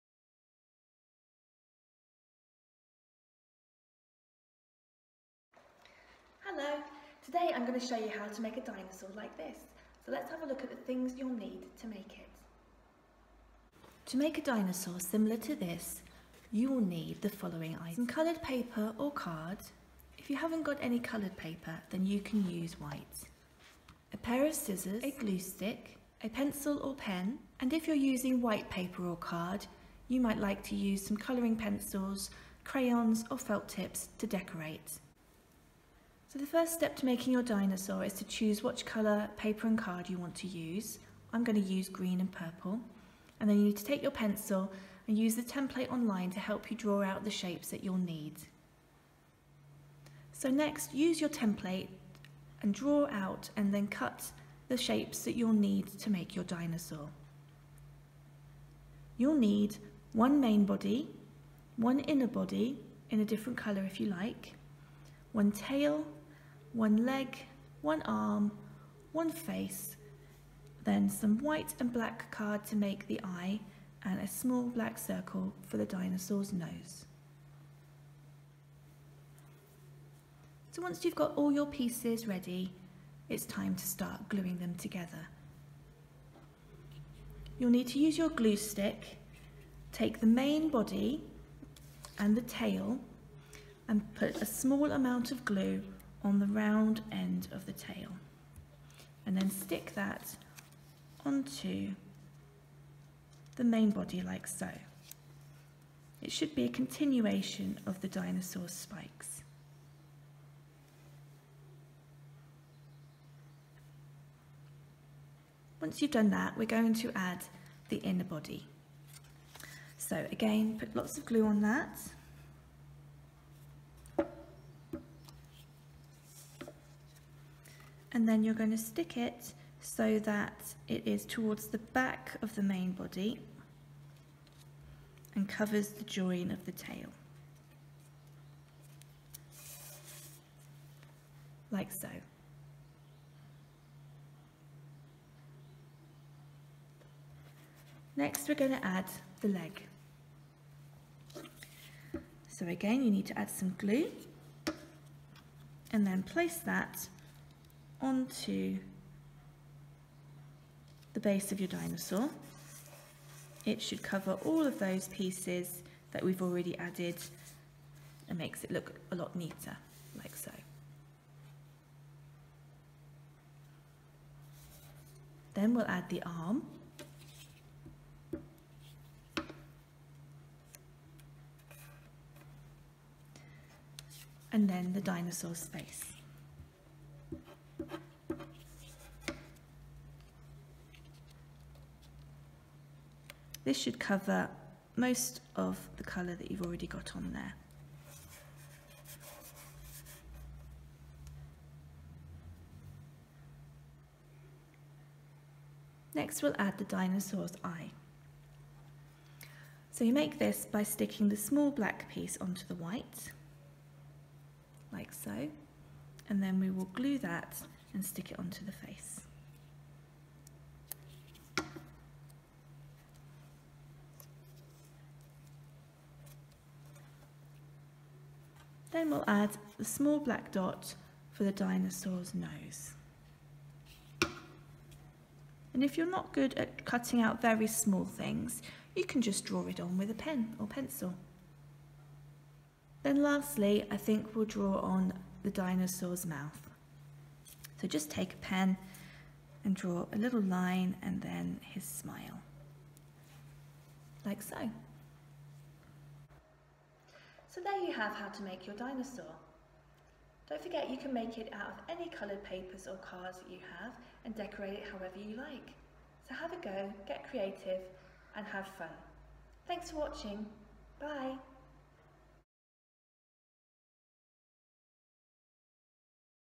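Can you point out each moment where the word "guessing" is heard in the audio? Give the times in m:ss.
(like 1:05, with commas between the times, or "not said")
not said.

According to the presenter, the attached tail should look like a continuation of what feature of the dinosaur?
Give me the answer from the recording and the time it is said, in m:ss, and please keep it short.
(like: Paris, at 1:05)
spikes, at 1:48.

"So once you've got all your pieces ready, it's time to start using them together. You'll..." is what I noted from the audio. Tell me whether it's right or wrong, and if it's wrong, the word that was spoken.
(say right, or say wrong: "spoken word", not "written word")
wrong: "gluing", not "using".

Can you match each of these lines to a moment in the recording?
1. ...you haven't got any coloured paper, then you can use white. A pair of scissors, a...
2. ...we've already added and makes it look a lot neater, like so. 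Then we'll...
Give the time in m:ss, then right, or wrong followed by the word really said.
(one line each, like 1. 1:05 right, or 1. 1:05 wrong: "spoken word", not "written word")
1. 0:20 right
2. 2:46 right.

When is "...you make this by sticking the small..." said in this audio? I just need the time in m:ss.
3:30.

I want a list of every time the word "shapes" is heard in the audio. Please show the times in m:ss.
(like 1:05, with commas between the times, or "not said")
0:47, 0:54.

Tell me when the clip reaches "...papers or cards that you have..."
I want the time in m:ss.
4:22.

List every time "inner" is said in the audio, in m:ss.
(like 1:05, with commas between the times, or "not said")
1:01, 1:57.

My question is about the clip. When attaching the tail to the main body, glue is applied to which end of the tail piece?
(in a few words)
round end.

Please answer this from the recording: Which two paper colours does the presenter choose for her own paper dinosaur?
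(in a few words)
green and purple.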